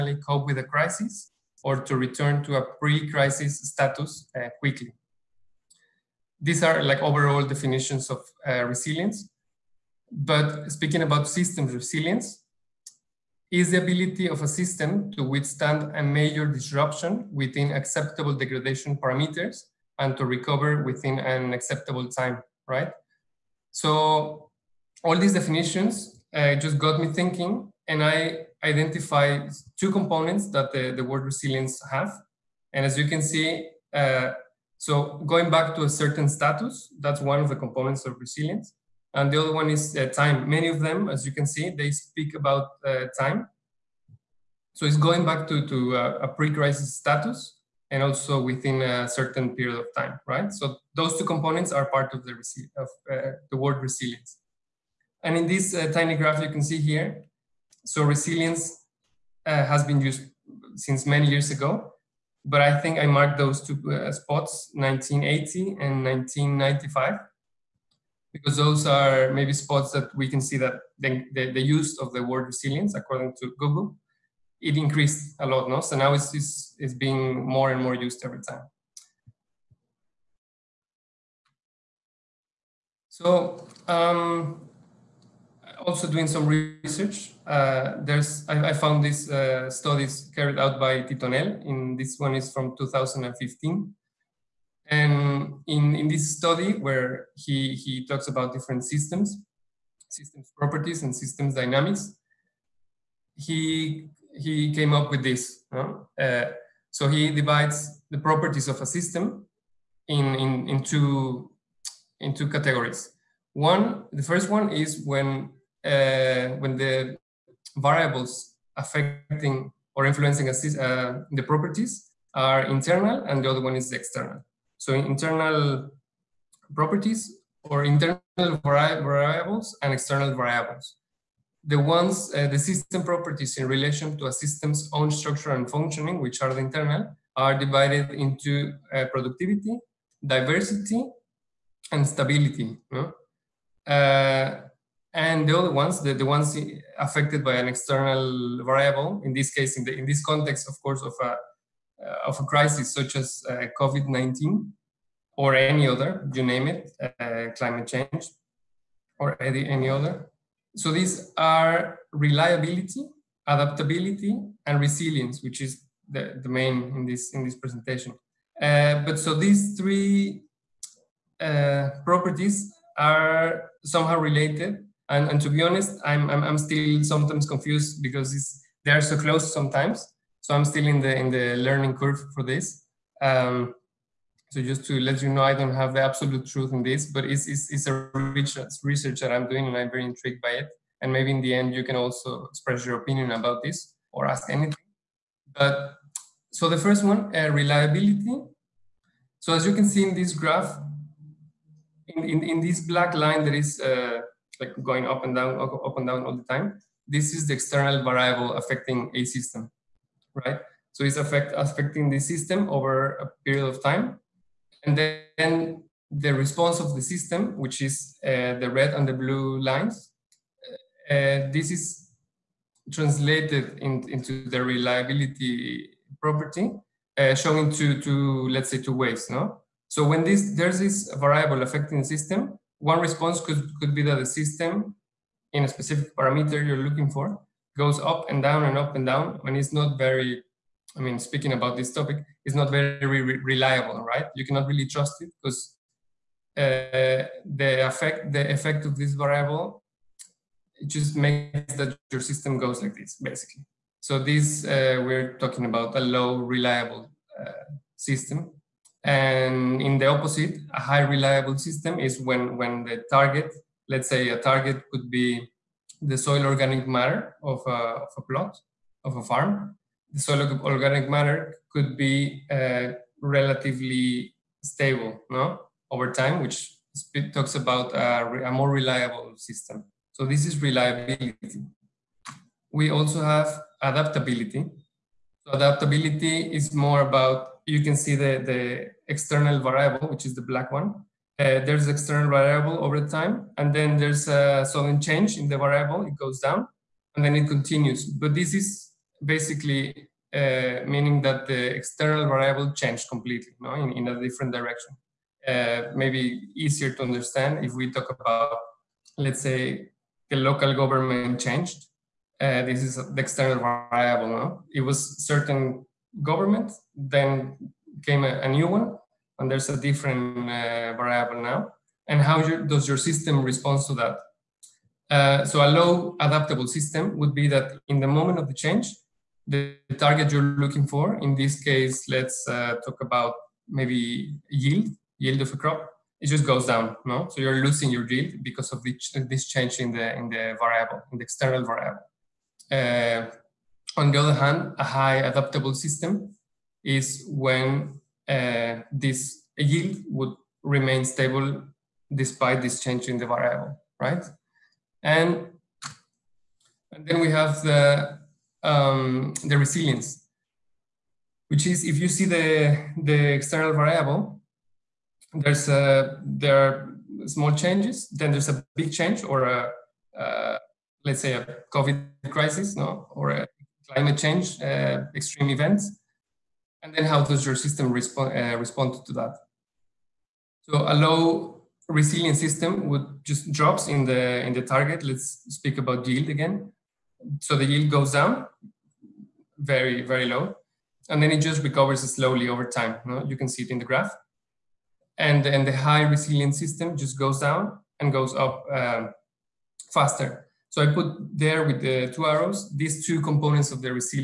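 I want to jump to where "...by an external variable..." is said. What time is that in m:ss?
2:27.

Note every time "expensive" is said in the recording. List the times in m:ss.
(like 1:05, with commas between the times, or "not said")
not said.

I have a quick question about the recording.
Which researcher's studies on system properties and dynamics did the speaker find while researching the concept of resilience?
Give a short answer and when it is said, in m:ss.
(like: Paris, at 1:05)
Tittonell, at 1:31.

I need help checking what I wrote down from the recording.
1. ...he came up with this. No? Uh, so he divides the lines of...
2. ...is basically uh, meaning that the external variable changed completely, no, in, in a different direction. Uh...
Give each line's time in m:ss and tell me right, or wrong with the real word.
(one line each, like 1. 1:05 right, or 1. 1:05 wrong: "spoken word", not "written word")
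1. 1:44 wrong: "properties", not "lines"
2. 4:58 right.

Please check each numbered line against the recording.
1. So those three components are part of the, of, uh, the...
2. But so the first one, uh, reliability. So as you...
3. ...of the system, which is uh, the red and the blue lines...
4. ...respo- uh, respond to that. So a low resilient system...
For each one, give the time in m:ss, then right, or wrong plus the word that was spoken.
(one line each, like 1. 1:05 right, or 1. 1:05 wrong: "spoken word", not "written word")
1. 0:50 wrong: "two", not "three"
2. 3:15 right
3. 3:36 right
4. 6:17 right.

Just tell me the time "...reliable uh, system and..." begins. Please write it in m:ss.
4:16.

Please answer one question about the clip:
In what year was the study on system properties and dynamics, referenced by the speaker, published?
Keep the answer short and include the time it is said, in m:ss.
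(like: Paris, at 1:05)
2015, at 1:32.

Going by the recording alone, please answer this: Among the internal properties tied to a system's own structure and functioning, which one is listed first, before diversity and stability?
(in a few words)
Productivity.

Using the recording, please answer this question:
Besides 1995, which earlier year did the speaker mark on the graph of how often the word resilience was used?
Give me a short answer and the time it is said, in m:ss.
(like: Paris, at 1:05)
1980, at 1:04.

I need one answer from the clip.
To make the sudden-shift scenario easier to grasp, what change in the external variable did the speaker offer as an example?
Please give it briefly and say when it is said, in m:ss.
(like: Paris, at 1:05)
The local government changed, at 5:10.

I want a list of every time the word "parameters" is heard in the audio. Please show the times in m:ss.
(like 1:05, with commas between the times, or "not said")
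0:18, 3:56.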